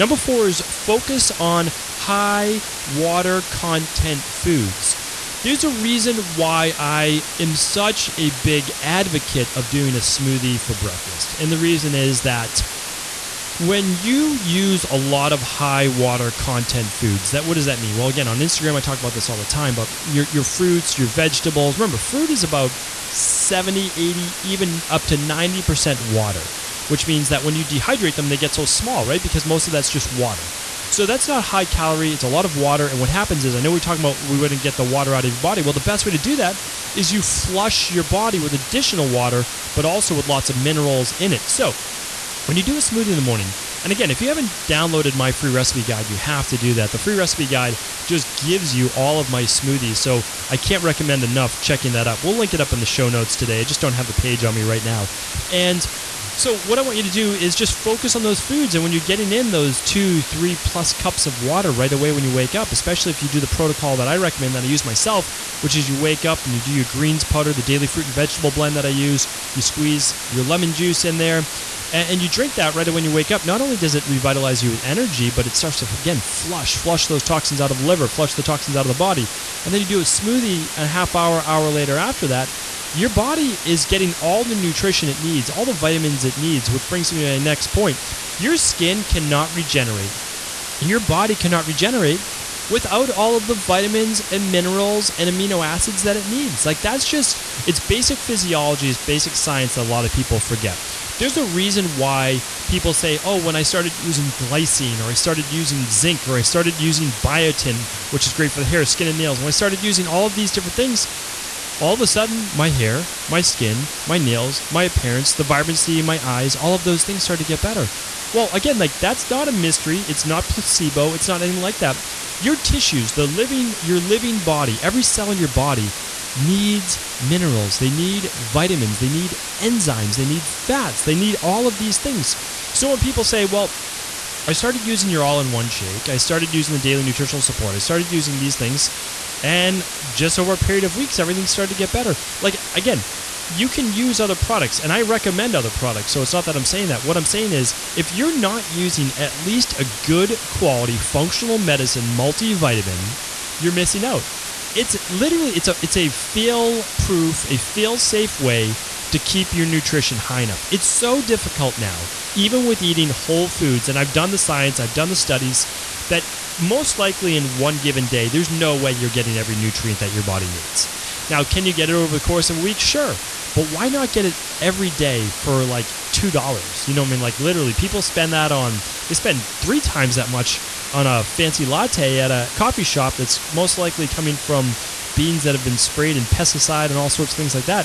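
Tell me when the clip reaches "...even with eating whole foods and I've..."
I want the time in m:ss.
2:42.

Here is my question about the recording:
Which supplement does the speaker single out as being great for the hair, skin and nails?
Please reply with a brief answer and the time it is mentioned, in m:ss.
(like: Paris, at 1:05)
biotin, at 1:47.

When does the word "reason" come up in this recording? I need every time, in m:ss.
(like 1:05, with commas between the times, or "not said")
0:05, 0:11, 1:41.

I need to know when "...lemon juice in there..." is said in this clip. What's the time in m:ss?
1:10.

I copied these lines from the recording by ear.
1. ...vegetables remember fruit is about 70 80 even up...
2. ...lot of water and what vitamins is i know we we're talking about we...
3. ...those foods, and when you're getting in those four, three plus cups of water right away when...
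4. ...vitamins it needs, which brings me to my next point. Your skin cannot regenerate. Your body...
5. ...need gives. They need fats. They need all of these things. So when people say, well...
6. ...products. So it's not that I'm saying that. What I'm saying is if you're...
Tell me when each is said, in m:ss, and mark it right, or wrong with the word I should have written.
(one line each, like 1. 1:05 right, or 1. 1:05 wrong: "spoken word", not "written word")
1. 0:21 right
2. 0:32 wrong: "happens", not "vitamins"
3. 0:58 wrong: "two", not "four"
4. 1:25 right
5. 2:09 wrong: "enzymes", not "gives"
6. 2:25 right.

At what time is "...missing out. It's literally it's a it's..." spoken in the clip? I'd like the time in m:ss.
2:33.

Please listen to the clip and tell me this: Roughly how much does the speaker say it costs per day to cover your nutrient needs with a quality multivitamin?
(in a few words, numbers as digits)
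2 dollars.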